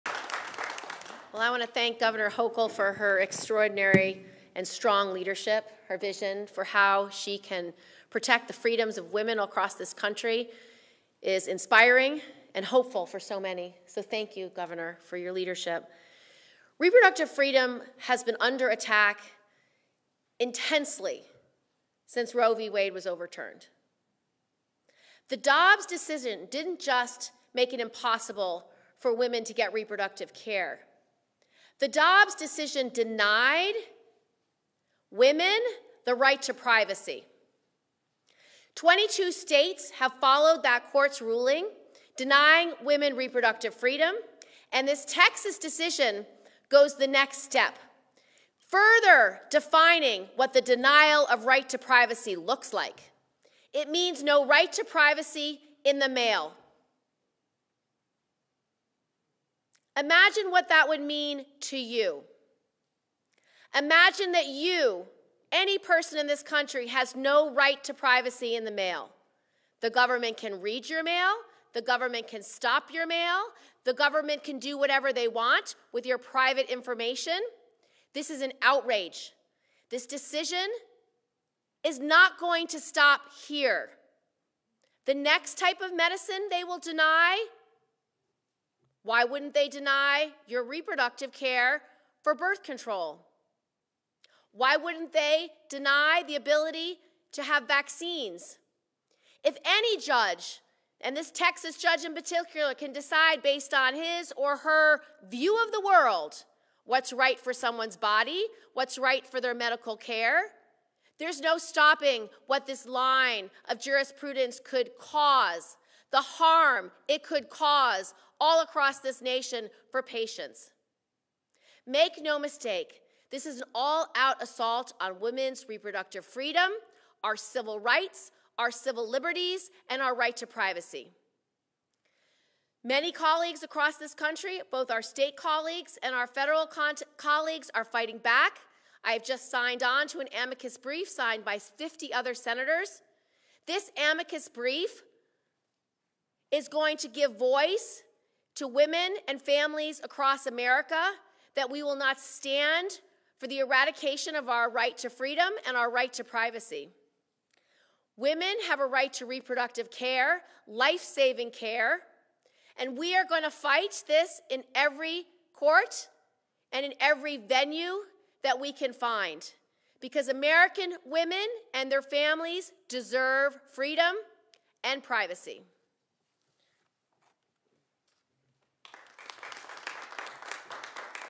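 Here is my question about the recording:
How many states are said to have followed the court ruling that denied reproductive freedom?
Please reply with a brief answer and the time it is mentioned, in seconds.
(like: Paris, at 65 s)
22, at 38 s.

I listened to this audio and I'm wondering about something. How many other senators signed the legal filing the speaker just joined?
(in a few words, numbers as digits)
50.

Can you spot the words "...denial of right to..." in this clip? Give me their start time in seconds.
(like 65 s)
50 s.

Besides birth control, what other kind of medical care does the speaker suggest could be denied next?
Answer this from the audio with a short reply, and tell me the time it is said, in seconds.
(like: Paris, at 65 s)
vaccines, at 97 s.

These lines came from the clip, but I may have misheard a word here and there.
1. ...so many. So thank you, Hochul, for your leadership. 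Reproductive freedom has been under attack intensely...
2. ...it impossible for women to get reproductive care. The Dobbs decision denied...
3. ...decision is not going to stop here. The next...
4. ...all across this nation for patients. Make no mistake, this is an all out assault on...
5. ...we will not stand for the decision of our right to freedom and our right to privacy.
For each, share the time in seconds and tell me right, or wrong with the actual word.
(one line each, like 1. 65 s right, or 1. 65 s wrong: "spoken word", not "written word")
1. 13 s wrong: "Governor", not "Hochul"
2. 27 s right
3. 80 s right
4. 118 s right
5. 151 s wrong: "eradication", not "decision".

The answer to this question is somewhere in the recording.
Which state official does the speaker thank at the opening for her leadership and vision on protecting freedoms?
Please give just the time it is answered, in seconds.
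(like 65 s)
1 s.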